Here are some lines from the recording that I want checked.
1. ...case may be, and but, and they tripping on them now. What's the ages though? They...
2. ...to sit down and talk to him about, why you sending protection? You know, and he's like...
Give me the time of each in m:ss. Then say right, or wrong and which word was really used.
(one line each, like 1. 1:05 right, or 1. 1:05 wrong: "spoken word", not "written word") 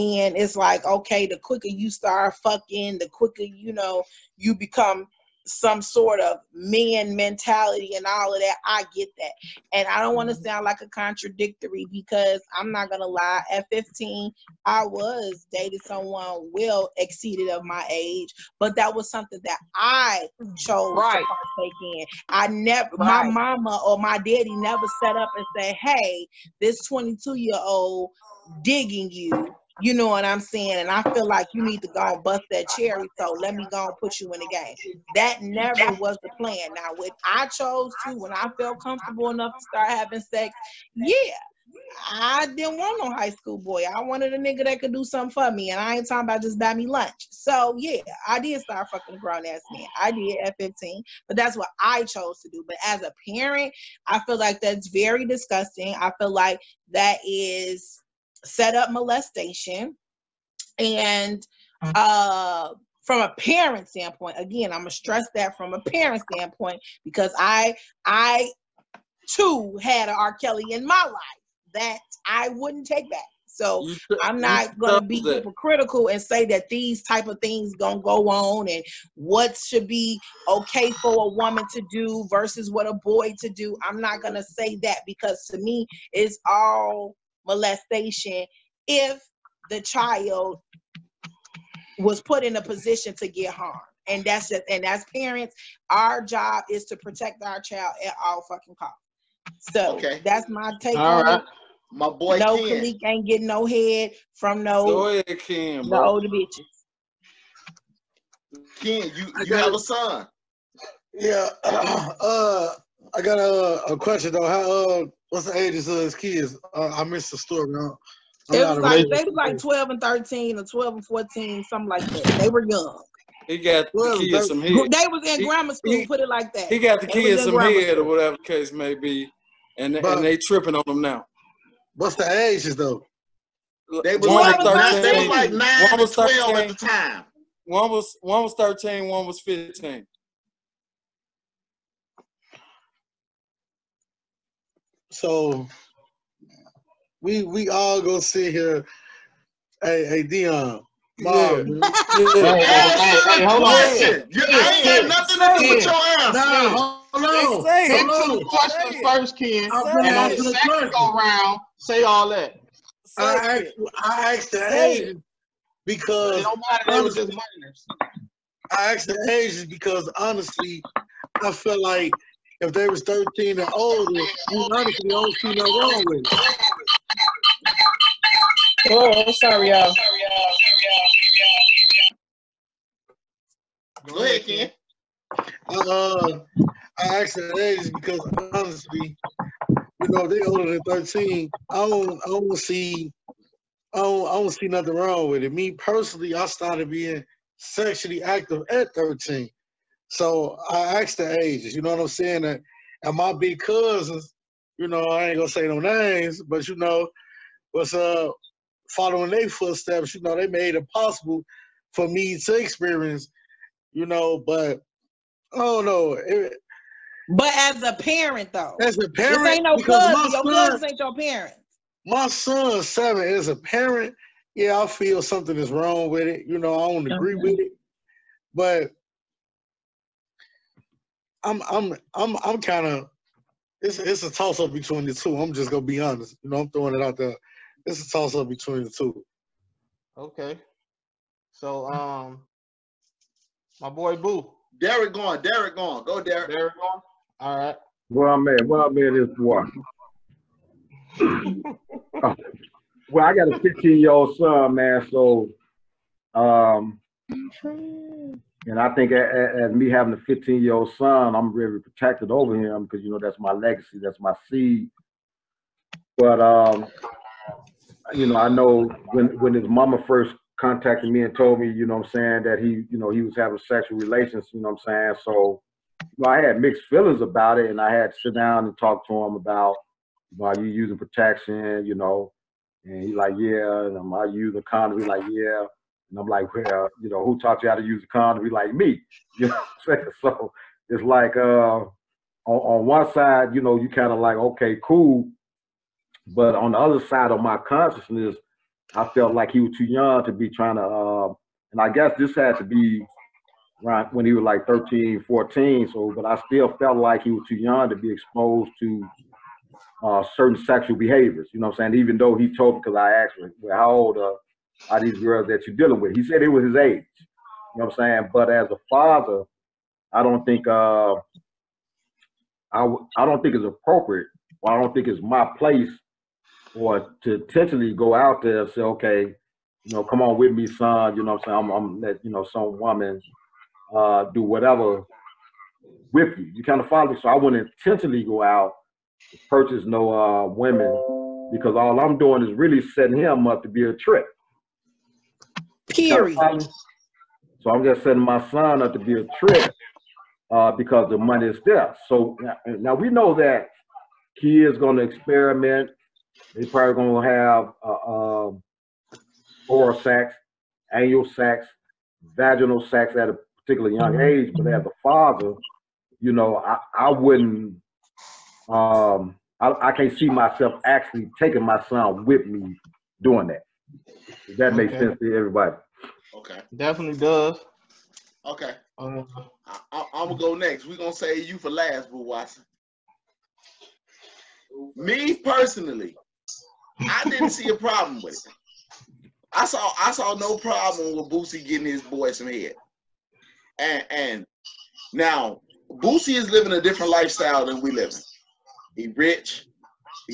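1. 2:08 right
2. 4:38 wrong: "using", not "sending".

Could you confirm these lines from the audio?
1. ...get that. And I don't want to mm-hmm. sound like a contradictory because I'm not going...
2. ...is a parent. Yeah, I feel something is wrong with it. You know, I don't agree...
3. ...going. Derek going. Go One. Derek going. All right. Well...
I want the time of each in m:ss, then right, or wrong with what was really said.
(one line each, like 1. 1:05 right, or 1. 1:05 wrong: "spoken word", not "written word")
1. 0:08 right
2. 3:43 right
3. 4:05 wrong: "Derek", not "One".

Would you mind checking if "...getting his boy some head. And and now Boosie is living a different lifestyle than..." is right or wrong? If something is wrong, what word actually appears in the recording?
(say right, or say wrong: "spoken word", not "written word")
right.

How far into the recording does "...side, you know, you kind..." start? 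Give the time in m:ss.
4:53.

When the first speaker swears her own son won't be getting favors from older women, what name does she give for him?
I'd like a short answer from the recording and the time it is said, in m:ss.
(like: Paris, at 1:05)
Kalik, at 1:42.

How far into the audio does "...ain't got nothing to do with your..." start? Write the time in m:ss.
2:34.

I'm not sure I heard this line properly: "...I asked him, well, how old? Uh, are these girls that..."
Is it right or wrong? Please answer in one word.
right.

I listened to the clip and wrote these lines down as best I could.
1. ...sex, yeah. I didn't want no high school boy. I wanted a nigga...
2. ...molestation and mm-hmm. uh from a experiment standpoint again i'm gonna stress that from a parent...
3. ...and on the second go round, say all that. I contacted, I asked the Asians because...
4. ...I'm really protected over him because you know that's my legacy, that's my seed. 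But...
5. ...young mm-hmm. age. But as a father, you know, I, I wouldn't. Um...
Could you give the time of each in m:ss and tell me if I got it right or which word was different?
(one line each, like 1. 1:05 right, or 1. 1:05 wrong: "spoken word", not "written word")
1. 0:40 right
2. 0:58 wrong: "parent", not "experiment"
3. 2:39 wrong: "asked", not "contacted"
4. 4:21 right
5. 6:03 right.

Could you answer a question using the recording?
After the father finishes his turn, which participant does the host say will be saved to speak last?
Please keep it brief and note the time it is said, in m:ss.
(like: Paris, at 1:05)
Boo Watson, at 6:22.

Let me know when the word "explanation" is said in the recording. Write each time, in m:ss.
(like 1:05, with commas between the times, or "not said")
not said.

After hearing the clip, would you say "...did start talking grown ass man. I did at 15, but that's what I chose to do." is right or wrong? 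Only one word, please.
wrong.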